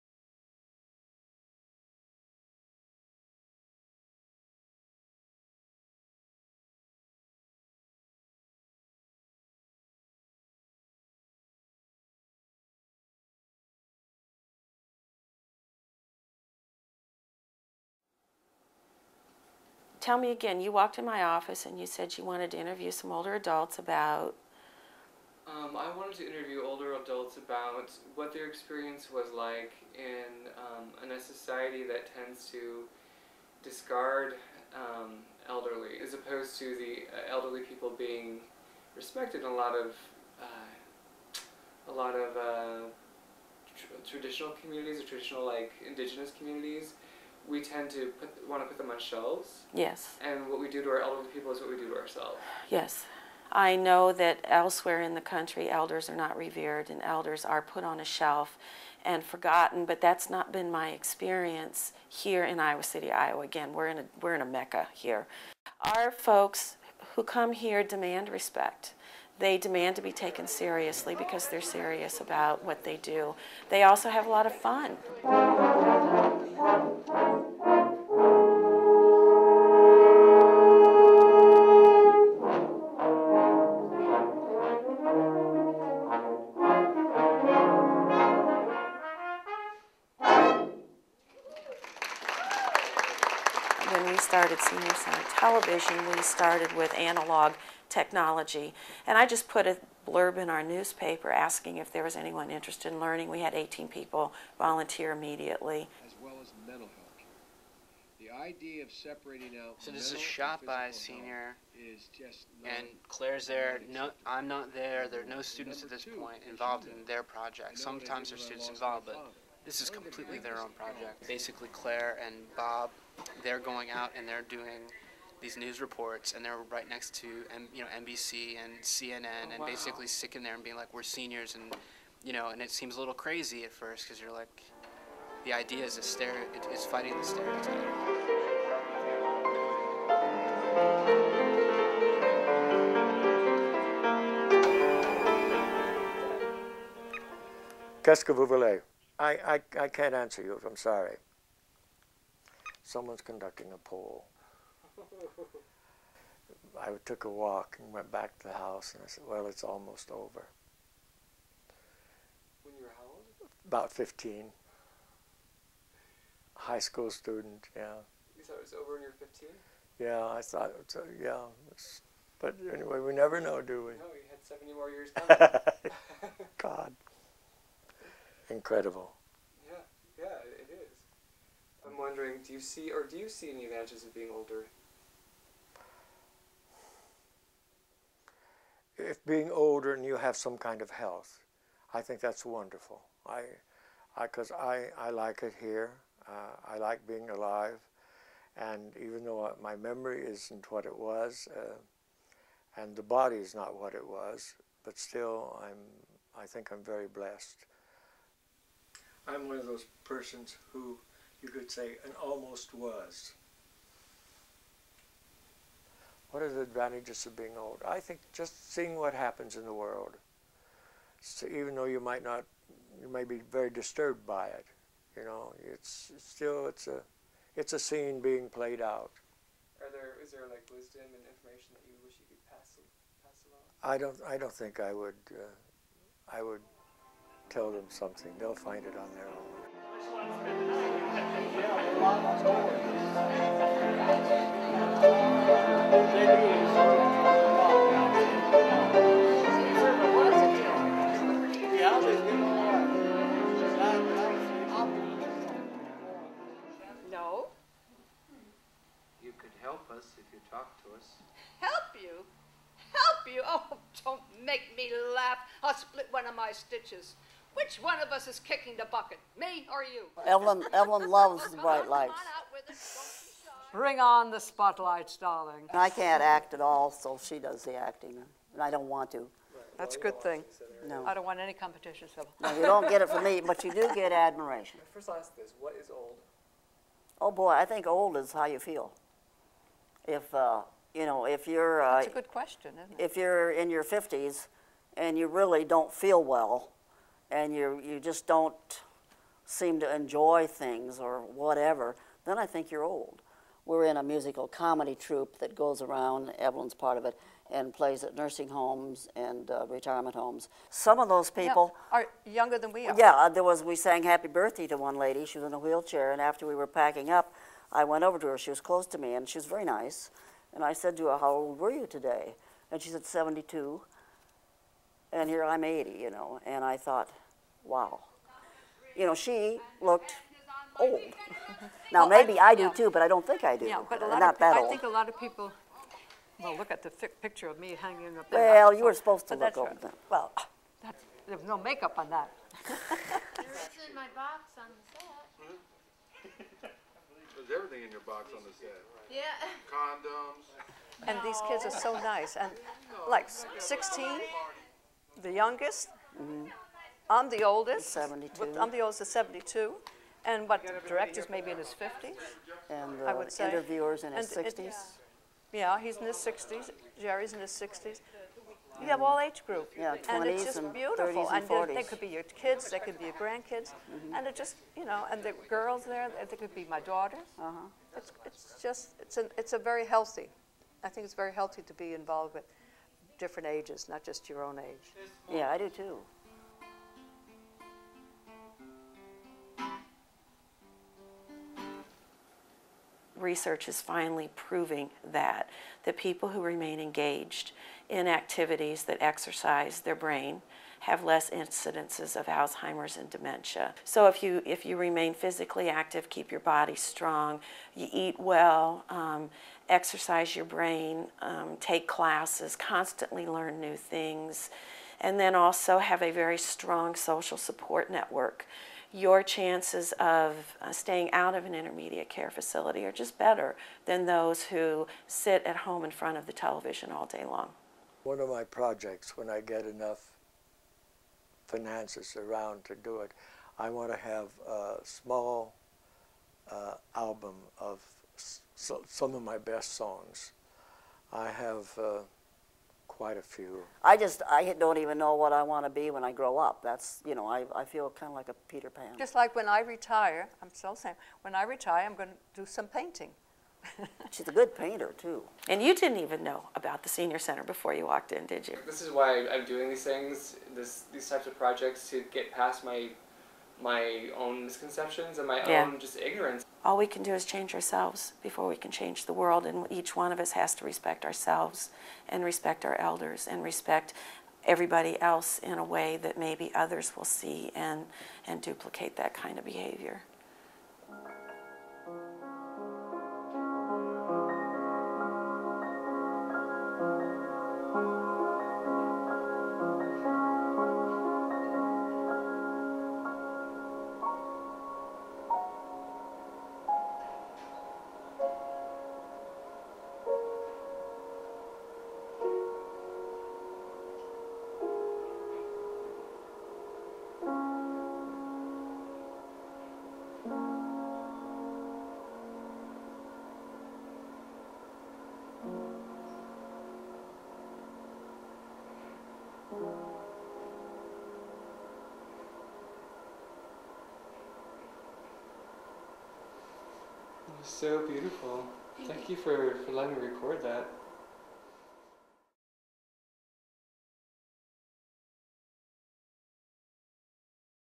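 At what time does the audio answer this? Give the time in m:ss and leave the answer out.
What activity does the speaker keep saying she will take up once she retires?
7:32.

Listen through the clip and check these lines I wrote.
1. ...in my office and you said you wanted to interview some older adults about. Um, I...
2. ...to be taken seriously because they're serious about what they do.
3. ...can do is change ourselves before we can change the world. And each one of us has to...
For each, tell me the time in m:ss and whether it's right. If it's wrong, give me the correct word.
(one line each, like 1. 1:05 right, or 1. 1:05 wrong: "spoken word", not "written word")
1. 0:20 right
2. 1:09 right
3. 7:46 right.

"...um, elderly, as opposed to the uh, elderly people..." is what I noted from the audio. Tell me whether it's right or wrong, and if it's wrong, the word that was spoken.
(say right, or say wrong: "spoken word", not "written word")
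right.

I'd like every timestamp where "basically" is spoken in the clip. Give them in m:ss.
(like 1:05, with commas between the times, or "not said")
2:01, 2:09.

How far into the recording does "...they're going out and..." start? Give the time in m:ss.
2:03.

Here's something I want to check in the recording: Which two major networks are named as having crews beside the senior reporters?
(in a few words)
NBC and CNN.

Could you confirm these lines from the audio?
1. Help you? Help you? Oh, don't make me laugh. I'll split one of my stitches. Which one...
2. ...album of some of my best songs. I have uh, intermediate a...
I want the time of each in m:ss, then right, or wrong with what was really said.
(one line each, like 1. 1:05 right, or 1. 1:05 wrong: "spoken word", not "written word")
1. 4:21 right
2. 7:16 wrong: "quite", not "intermediate".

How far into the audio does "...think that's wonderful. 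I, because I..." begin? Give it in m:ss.
3:12.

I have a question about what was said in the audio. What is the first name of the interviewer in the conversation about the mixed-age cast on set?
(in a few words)
Jerry.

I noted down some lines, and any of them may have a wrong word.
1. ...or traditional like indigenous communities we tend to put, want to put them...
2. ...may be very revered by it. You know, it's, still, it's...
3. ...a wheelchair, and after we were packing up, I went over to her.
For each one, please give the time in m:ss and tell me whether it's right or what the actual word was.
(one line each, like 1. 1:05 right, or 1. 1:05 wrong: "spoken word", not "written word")
1. 0:45 right
2. 3:43 wrong: "disturbed", not "revered"
3. 5:15 right.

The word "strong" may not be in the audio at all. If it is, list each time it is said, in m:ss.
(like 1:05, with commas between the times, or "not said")
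6:46, 6:56.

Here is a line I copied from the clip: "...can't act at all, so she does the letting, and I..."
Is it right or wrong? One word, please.
wrong.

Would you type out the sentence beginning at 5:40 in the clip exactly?
Well, that's, there's no makeup on that.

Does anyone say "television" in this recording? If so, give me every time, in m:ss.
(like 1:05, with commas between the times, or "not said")
1:35, 7:06.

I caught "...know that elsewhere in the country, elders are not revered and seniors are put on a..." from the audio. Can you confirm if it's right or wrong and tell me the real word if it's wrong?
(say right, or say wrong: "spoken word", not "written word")
wrong: "elders", not "seniors".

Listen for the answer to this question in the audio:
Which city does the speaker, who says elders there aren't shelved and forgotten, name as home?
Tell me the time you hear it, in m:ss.
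1:02.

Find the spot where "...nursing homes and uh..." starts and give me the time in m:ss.
5:08.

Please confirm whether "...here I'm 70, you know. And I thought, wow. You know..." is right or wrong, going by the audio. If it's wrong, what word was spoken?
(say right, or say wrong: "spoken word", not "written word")
wrong: "80", not "70".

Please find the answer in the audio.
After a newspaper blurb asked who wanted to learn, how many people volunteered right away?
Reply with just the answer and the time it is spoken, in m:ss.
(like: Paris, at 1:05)
18, at 1:43.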